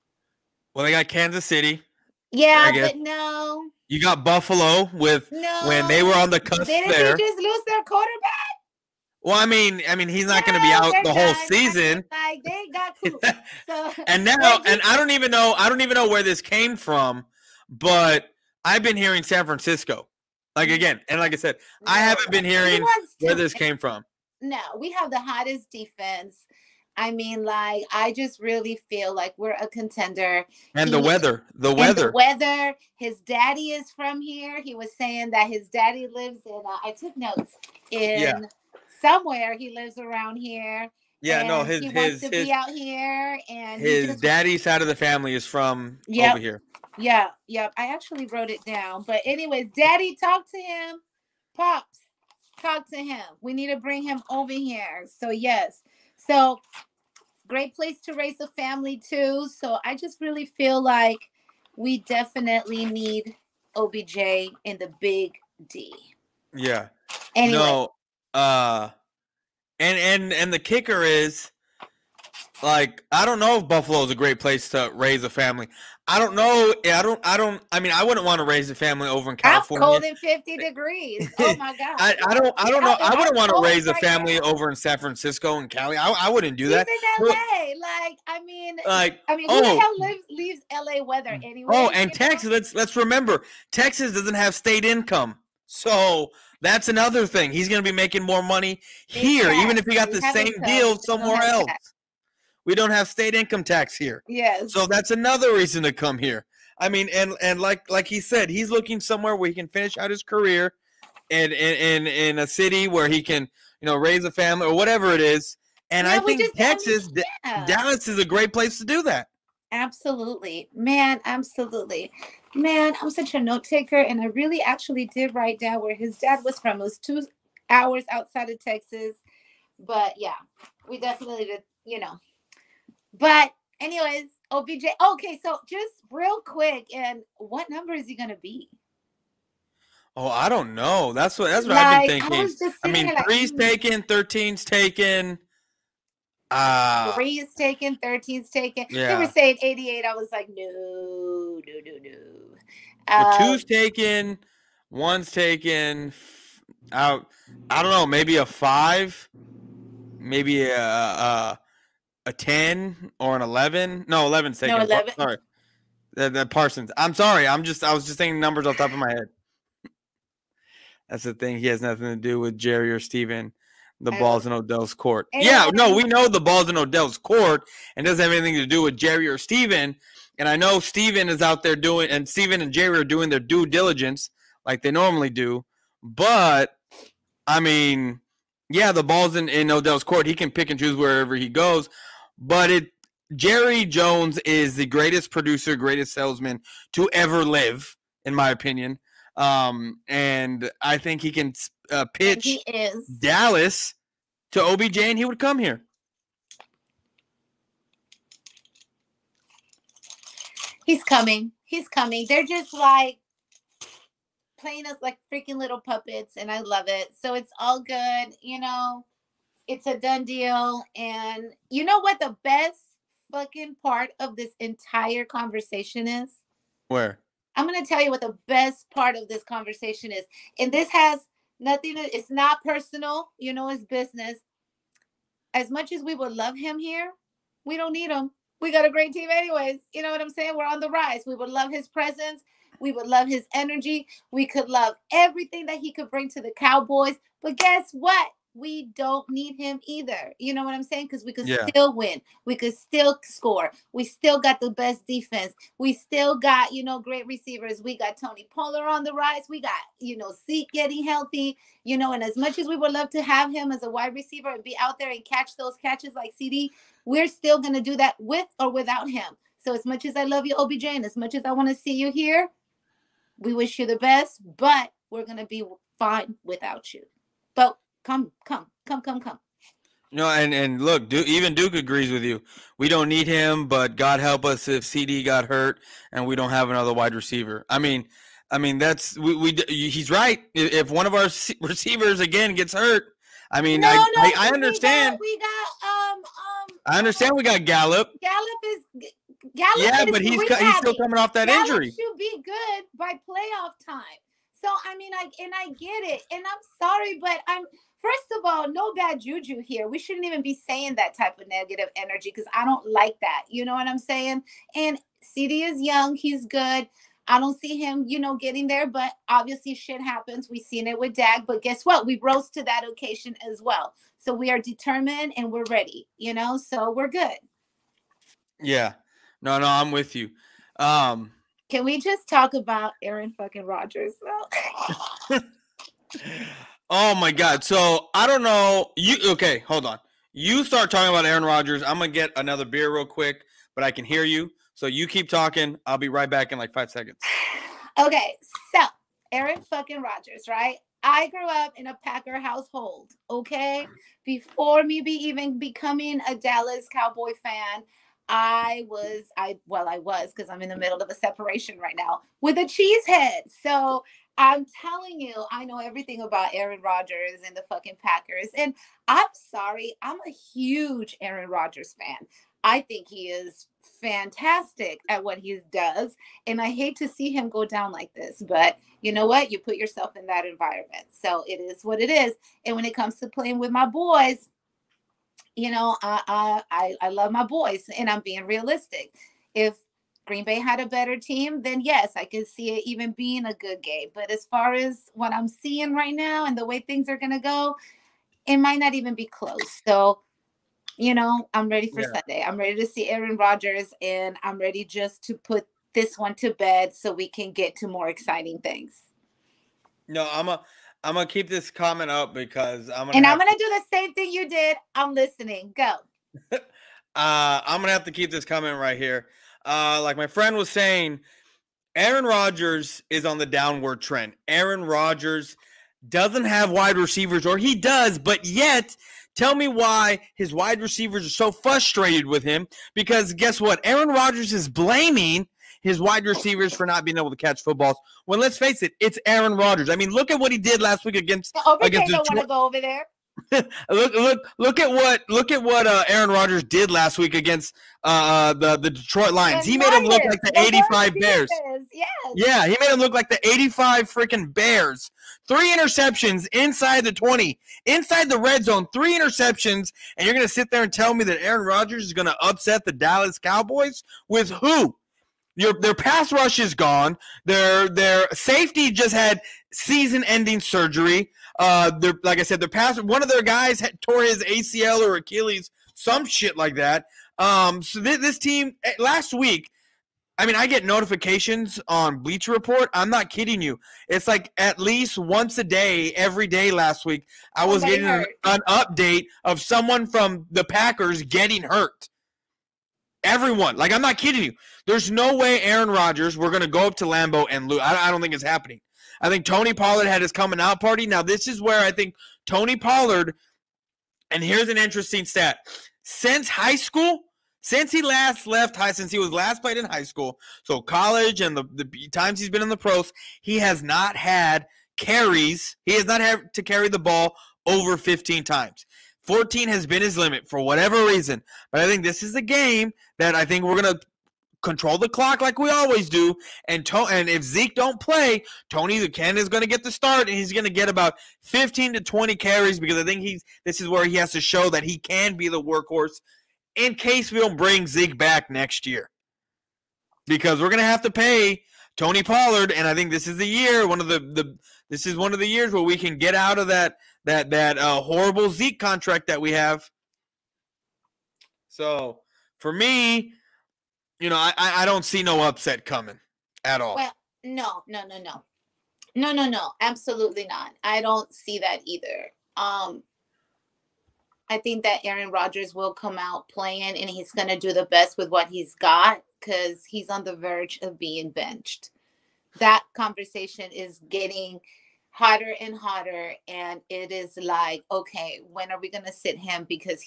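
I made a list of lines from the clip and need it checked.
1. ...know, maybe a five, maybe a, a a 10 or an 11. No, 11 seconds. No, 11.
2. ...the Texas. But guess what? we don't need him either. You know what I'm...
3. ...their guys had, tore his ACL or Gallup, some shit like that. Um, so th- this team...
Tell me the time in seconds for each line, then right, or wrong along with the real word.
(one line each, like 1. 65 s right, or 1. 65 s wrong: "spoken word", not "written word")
1. 157 s right
2. 246 s wrong: "Cowboys", not "Texas"
3. 473 s wrong: "Achilles", not "Gallup".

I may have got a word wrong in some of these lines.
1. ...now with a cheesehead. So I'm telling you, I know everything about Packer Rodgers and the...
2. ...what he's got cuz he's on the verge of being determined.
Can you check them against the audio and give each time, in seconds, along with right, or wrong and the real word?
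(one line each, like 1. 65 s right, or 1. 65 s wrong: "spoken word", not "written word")
1. 361 s wrong: "Aaron", not "Packer"
2. 568 s wrong: "benched", not "determined".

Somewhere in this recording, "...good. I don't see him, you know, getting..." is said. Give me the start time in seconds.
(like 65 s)
316 s.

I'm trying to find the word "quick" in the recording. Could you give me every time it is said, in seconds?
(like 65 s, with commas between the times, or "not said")
136 s, 343 s.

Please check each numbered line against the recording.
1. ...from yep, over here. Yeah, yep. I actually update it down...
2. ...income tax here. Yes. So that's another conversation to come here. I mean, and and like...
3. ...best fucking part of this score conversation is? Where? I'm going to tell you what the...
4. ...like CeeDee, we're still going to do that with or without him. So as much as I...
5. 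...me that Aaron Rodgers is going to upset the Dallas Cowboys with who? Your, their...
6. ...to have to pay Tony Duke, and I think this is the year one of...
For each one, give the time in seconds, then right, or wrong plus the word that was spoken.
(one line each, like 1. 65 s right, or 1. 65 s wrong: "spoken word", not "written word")
1. 45 s wrong: "wrote", not "update"
2. 103 s wrong: "reason", not "conversation"
3. 222 s wrong: "entire", not "score"
4. 266 s right
5. 461 s right
6. 540 s wrong: "Pollard", not "Duke".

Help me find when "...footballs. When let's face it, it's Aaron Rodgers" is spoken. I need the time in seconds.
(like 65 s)
437 s.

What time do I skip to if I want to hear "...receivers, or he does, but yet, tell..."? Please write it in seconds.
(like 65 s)
426 s.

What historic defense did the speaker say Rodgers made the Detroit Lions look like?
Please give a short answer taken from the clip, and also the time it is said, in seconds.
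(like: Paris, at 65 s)
the 85 Bears, at 450 s.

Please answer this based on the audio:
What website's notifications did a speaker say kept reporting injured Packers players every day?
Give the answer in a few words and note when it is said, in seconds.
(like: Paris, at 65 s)
Bleacher Report, at 482 s.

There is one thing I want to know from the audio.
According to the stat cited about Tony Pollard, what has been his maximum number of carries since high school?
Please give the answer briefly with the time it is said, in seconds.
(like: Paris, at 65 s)
14, at 519 s.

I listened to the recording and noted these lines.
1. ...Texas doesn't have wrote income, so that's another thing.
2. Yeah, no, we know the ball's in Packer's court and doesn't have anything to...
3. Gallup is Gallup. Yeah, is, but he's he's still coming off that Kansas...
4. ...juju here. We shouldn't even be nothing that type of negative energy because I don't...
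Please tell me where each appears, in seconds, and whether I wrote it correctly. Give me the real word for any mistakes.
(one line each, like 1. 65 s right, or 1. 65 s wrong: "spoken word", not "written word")
1. 93 s wrong: "state", not "wrote"
2. 175 s wrong: "Odell", not "Packer"
3. 298 s wrong: "Gallup", not "Kansas"
4. 309 s wrong: "saying", not "nothing".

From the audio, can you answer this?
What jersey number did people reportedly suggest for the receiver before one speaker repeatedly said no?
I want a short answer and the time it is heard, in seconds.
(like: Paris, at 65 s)
88, at 149 s.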